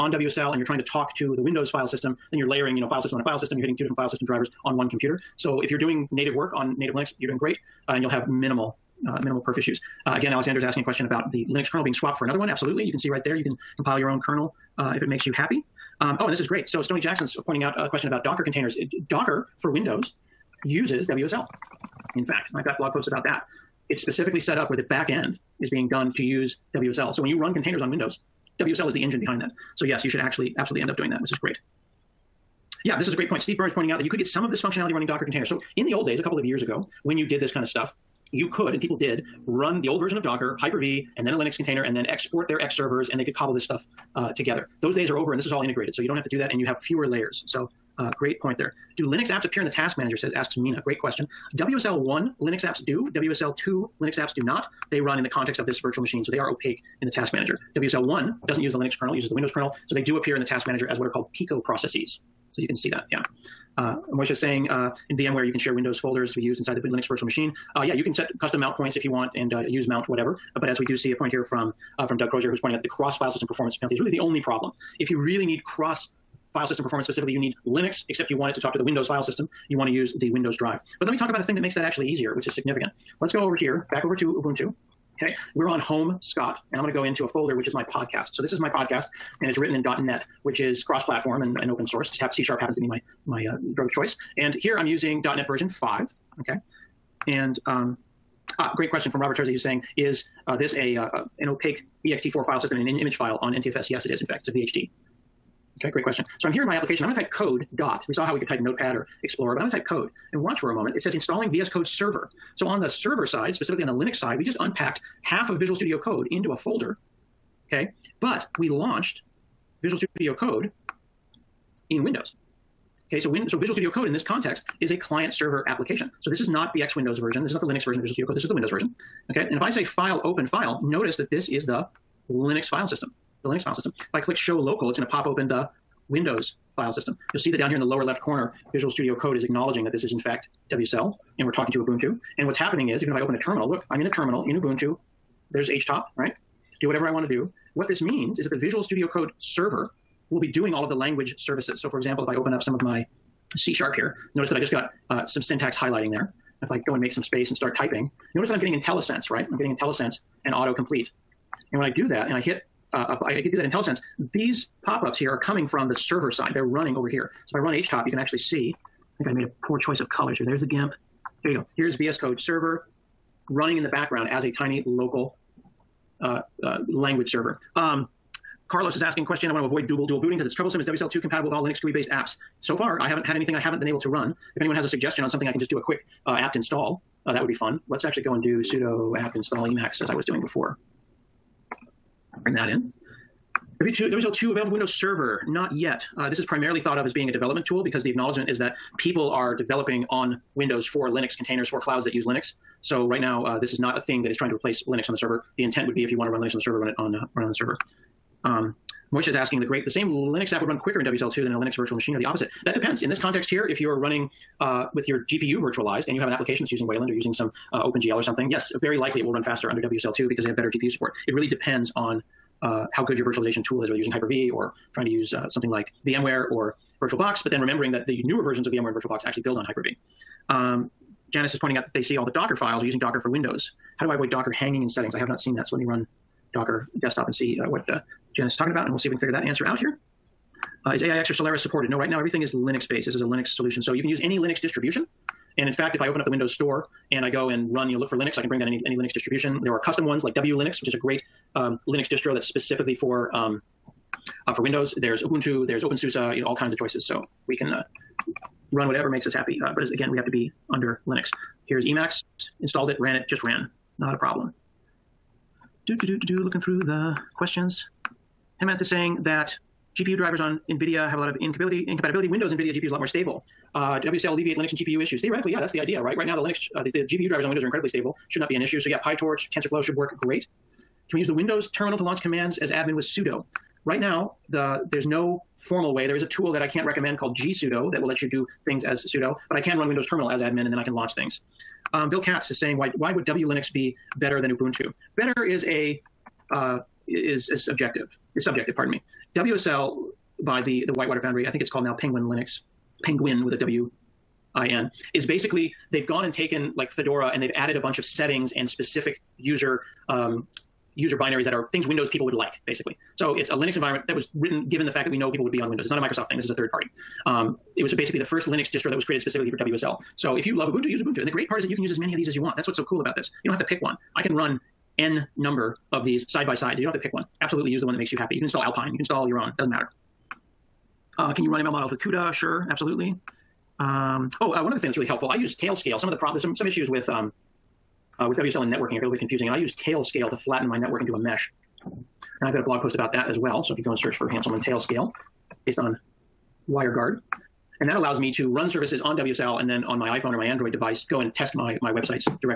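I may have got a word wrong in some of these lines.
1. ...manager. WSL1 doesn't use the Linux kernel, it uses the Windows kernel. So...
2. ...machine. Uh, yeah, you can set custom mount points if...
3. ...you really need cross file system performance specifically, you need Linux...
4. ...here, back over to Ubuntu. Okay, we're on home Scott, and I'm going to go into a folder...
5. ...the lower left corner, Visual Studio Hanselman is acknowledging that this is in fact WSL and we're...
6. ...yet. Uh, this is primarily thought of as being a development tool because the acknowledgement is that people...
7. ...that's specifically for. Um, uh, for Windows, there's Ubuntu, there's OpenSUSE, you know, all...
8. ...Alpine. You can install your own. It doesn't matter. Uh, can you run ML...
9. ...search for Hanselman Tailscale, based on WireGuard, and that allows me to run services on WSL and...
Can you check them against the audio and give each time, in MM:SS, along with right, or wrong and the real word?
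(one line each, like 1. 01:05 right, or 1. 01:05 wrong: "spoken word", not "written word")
1. 00:57 right
2. 01:07 right
3. 01:15 right
4. 01:23 right
5. 02:17 wrong: "Code", not "Hanselman"
6. 03:15 right
7. 04:12 right
8. 05:28 right
9. 05:43 right.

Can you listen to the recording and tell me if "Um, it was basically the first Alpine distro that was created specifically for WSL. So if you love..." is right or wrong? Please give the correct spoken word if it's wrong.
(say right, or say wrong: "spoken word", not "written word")
wrong: "Linux", not "Alpine".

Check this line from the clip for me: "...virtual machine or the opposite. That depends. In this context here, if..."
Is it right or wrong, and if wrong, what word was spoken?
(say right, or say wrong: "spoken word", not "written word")
right.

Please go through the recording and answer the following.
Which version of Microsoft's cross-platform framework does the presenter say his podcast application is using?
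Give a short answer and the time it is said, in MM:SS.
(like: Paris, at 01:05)
.NET 5, at 01:35.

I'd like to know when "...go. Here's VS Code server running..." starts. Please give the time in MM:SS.
02:51.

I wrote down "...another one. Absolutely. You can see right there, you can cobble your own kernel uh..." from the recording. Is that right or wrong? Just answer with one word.
wrong.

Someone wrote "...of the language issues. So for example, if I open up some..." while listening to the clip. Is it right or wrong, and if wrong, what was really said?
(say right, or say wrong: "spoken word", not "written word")
wrong: "services", not "issues".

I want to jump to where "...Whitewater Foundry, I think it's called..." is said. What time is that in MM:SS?
05:00.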